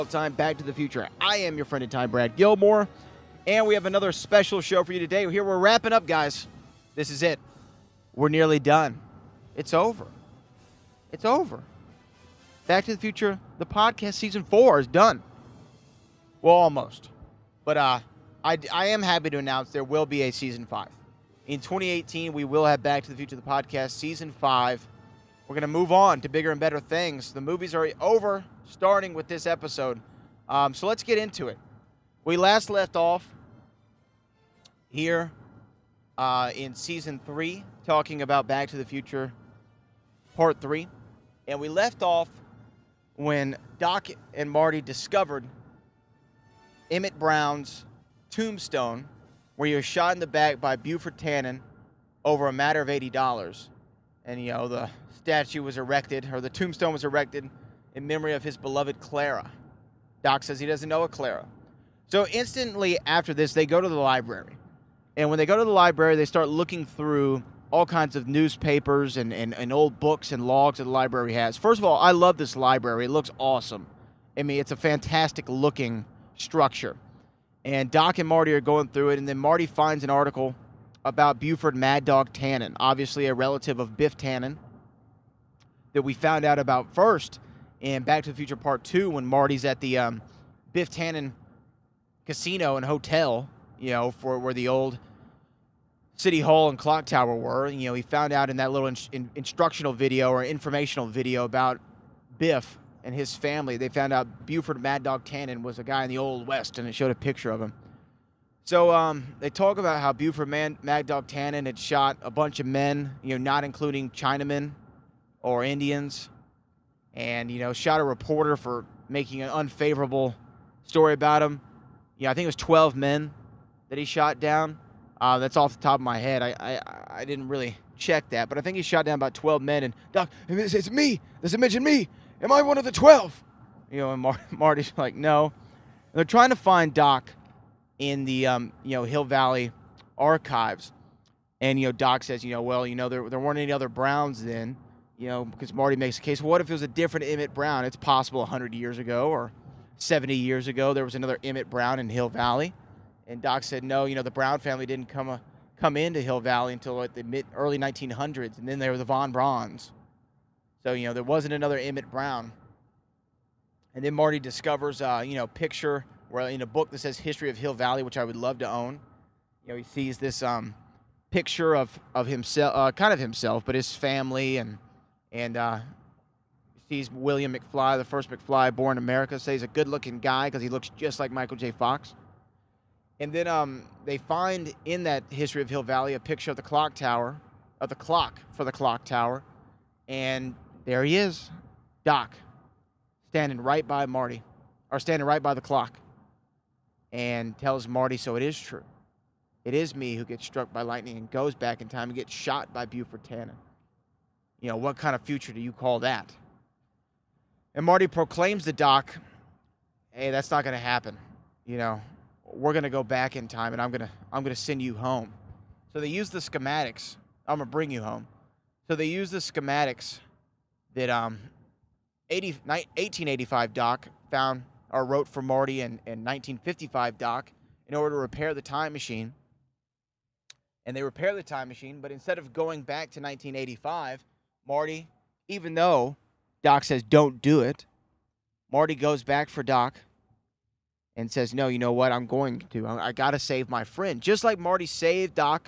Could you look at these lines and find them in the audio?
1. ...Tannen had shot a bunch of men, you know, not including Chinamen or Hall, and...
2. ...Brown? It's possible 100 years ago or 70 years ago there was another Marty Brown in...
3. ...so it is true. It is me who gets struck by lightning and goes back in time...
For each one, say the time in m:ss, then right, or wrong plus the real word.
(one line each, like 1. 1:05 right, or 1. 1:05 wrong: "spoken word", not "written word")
1. 1:51 wrong: "Indians", not "Hall"
2. 2:27 wrong: "Emmett", not "Marty"
3. 3:18 right.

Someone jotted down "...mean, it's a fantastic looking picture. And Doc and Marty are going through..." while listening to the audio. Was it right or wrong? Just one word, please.
wrong.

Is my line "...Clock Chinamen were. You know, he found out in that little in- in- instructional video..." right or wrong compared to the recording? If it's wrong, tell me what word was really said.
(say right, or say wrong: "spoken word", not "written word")
wrong: "Tower", not "Chinamen".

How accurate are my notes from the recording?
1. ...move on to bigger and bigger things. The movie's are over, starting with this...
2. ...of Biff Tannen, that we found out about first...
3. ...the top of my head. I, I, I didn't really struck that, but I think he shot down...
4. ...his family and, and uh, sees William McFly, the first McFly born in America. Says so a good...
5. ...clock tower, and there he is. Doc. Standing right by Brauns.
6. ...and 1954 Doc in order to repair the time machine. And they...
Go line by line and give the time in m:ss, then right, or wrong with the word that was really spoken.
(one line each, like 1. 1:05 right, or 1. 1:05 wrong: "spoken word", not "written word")
1. 0:25 wrong: "better", not "bigger"
2. 1:23 right
3. 2:05 wrong: "check", not "struck"
4. 2:53 right
5. 3:08 wrong: "Marty", not "Brauns"
6. 3:46 wrong: "1955", not "1954".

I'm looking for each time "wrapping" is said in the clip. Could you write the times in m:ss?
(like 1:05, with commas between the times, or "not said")
0:05.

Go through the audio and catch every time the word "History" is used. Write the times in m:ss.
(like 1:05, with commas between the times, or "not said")
2:47, 3:05.